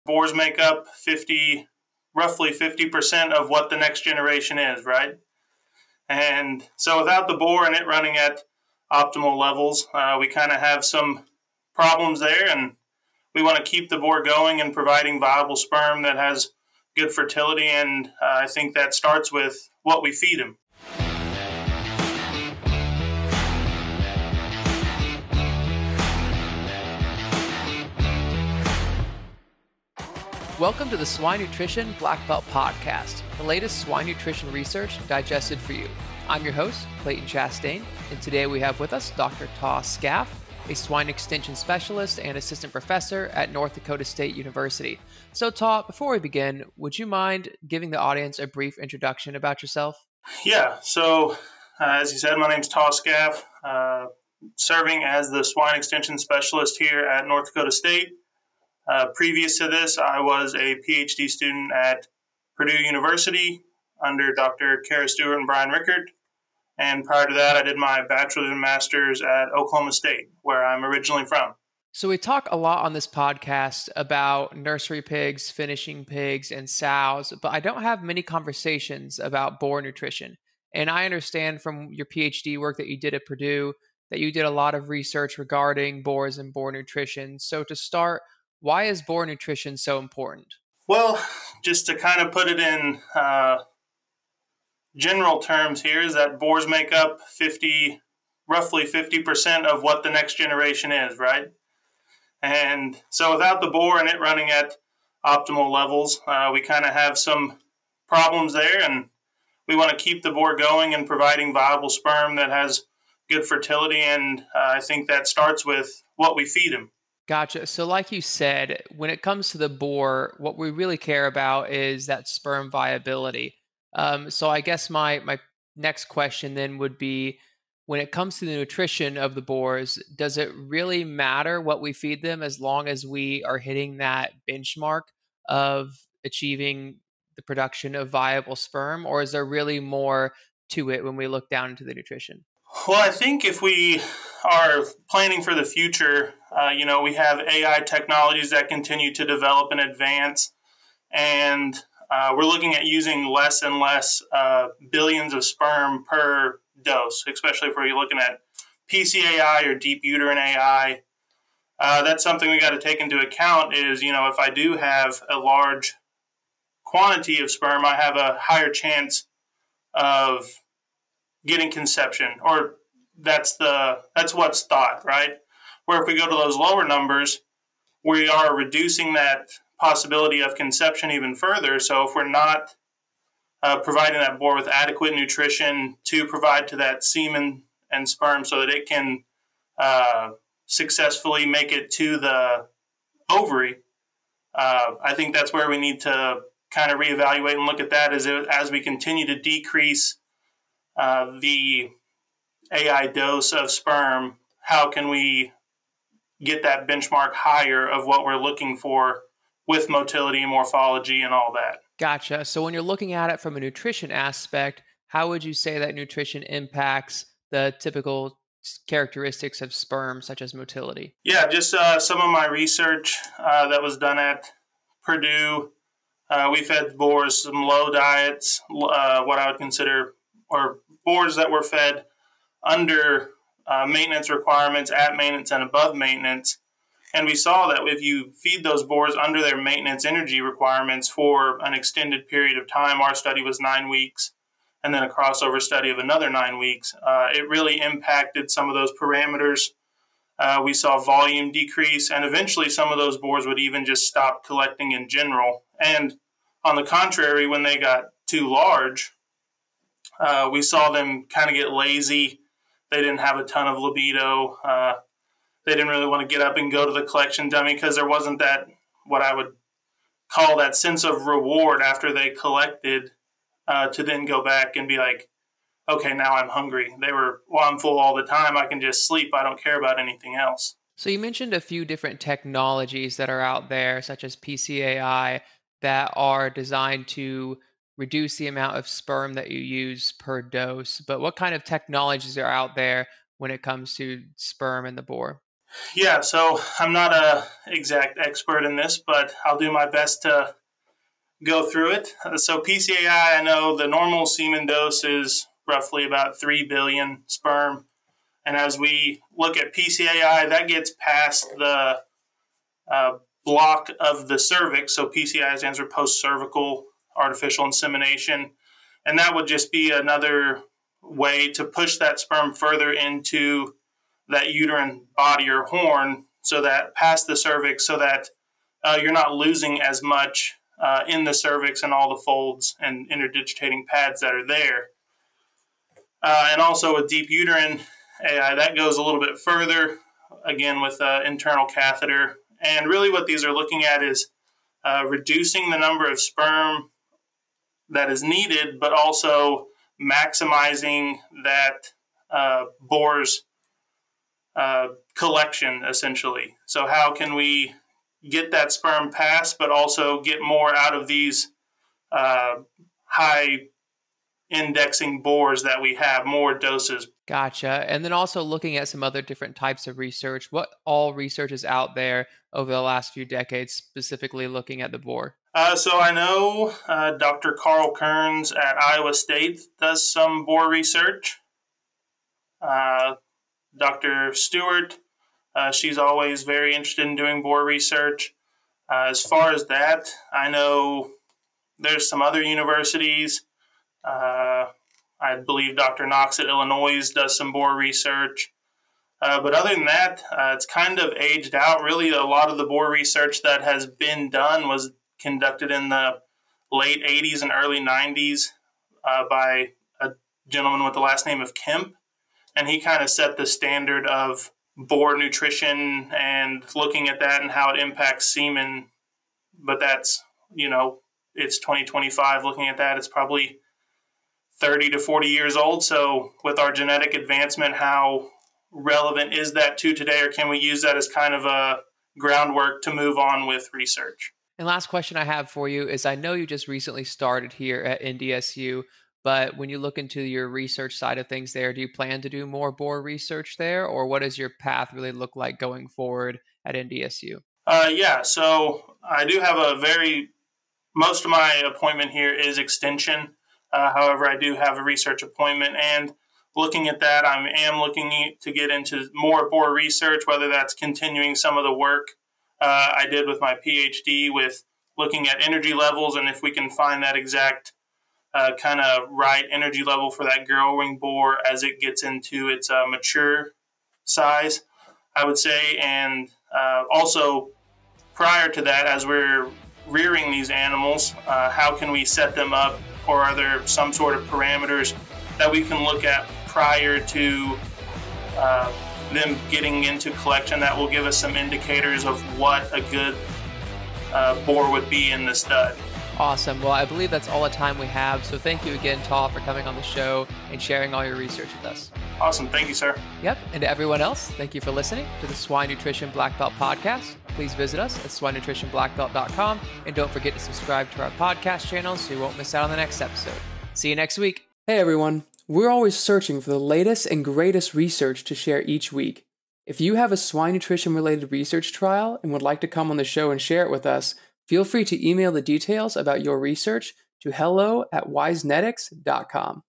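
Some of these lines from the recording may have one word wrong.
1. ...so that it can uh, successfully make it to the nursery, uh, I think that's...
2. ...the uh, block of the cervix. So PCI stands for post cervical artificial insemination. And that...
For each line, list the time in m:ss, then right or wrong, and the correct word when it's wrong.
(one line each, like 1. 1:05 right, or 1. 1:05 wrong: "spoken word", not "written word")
1. 3:08 wrong: "ovary", not "nursery"
2. 5:11 right.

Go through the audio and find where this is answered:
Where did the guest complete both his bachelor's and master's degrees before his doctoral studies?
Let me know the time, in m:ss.
1:09.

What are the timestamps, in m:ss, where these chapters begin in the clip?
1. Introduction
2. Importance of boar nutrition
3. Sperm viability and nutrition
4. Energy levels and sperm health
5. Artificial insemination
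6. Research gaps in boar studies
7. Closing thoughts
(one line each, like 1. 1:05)
1. 0:30
2. 1:17
3. 1:59
4. 3:33
5. 4:52
6. 6:10
7. 8:15.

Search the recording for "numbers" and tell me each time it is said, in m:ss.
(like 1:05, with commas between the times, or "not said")
2:56, 5:45.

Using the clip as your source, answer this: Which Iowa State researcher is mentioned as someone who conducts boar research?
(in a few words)
Carl Kearns.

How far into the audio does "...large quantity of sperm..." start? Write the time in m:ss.
2:45.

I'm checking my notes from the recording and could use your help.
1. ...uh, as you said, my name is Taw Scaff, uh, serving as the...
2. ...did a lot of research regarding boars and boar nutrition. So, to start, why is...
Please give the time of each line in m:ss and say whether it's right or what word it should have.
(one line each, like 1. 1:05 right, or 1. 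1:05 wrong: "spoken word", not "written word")
1. 0:51 right
2. 1:24 right.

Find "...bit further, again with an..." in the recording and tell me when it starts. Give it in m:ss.
5:39.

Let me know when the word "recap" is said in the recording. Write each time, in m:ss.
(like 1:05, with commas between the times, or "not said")
not said.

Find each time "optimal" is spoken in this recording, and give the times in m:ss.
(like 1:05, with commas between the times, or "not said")
0:08, 1:45.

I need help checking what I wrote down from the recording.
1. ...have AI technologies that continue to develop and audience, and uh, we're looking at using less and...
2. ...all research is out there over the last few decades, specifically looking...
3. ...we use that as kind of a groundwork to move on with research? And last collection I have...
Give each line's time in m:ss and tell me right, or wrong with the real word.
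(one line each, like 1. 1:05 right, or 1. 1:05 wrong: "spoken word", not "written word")
1. 2:27 wrong: "advance", not "audience"
2. 6:10 right
3. 7:10 wrong: "question", not "collection".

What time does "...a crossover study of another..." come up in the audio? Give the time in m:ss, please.
4:05.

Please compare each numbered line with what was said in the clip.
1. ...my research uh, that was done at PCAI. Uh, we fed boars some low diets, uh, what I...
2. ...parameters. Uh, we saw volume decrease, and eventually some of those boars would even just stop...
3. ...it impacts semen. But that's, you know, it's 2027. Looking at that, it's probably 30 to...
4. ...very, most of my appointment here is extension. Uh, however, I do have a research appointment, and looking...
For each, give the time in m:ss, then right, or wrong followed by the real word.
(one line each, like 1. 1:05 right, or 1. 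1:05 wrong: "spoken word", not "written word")
1. 3:42 wrong: "Purdue", not "PCAI"
2. 4:09 right
3. 6:57 wrong: "2025", not "2027"
4. 7:29 right.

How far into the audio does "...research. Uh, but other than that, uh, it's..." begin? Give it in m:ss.
6:37.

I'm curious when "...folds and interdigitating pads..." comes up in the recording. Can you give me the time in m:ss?
5:32.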